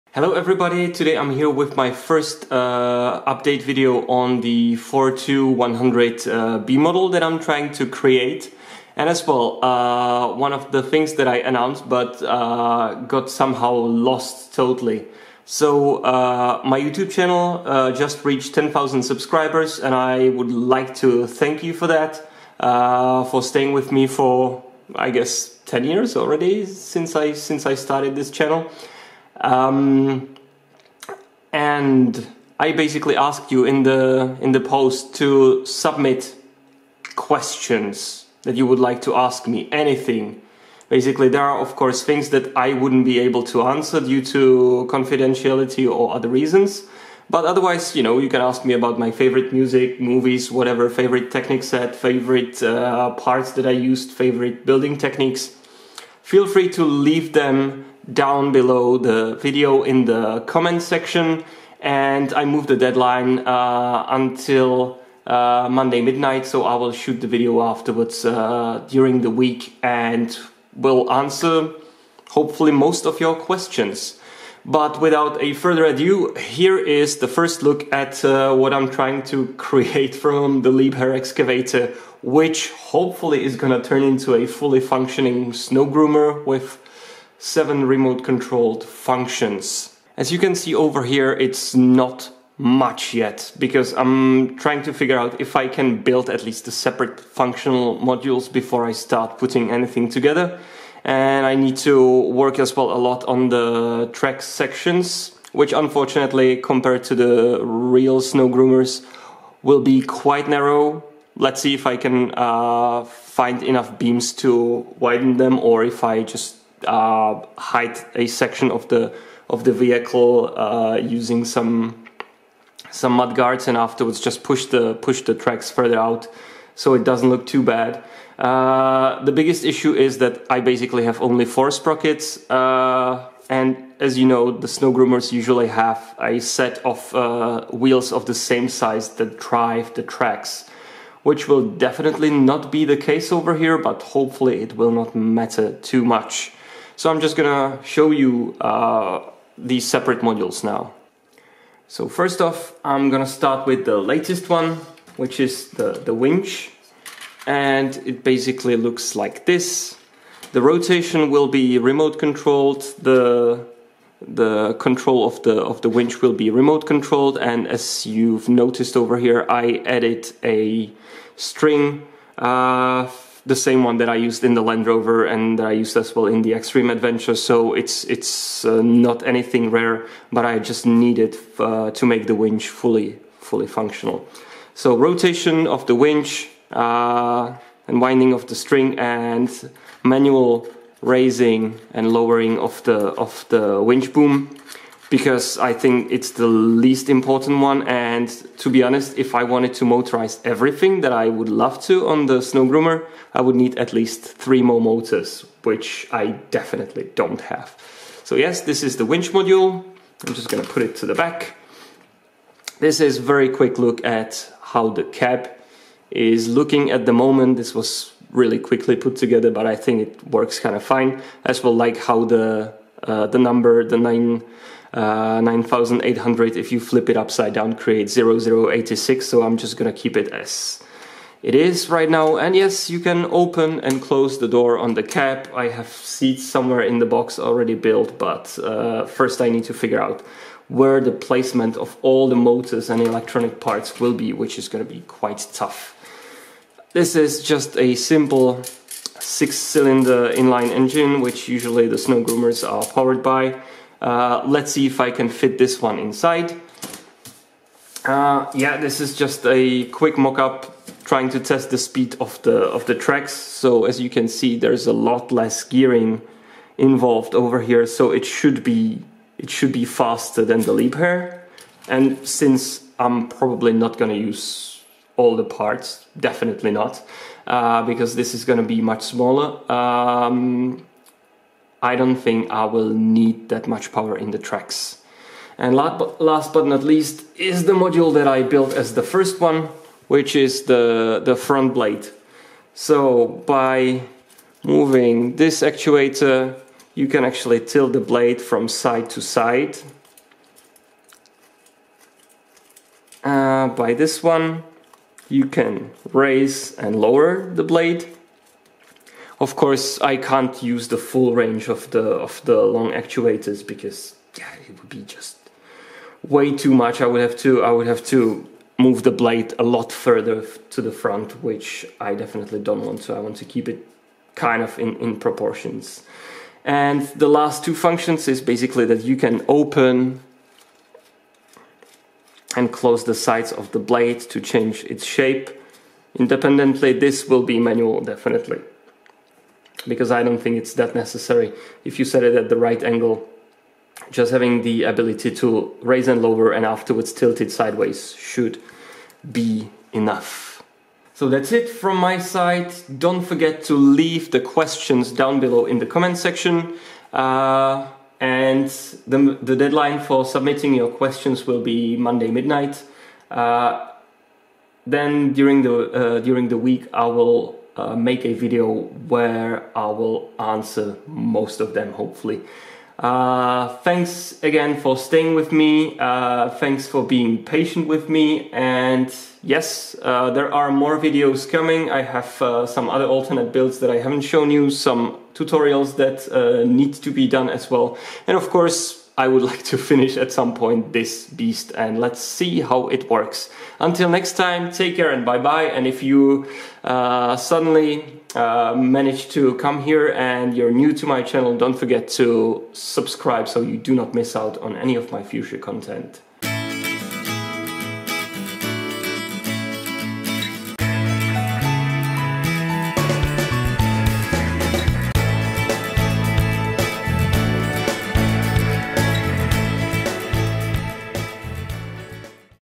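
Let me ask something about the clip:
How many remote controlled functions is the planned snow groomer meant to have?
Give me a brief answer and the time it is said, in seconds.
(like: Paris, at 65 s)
7, at 87 s.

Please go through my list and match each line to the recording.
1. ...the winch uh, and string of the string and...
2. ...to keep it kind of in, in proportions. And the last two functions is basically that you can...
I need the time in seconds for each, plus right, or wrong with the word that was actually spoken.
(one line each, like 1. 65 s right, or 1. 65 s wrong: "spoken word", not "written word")
1. 185 s wrong: "winding", not "string"
2. 323 s right.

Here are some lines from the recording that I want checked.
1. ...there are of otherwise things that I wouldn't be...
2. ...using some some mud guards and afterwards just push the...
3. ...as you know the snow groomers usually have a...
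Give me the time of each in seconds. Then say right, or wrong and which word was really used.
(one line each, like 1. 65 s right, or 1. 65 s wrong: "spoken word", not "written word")
1. 41 s wrong: "course", not "otherwise"
2. 120 s right
3. 133 s right.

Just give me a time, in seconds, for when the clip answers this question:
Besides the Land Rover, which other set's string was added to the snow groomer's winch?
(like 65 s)
176 s.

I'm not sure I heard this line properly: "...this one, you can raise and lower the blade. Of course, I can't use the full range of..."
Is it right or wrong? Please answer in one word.
right.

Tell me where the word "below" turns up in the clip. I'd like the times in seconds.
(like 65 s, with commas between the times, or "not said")
58 s, 355 s.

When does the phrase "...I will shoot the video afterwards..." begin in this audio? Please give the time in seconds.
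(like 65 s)
66 s.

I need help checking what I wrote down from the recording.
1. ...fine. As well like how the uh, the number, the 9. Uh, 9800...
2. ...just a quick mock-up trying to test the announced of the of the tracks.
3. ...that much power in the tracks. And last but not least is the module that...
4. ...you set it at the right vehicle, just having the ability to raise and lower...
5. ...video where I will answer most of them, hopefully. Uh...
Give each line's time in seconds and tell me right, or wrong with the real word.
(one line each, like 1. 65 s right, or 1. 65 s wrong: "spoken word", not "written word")
1. 220 s right
2. 259 s wrong: "speed", not "announced"
3. 283 s right
4. 341 s wrong: "angle", not "vehicle"
5. 368 s right.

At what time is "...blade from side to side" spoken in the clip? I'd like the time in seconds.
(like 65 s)
297 s.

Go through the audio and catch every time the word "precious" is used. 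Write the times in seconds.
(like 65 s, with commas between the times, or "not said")
not said.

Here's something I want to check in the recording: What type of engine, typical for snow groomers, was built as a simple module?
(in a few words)
six-cylinder inline engine.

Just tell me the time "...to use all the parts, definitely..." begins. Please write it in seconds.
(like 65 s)
274 s.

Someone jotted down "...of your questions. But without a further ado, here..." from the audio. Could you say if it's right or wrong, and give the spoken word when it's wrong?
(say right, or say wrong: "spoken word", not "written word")
right.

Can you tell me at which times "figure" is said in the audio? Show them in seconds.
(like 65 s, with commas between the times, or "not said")
94 s, 239 s.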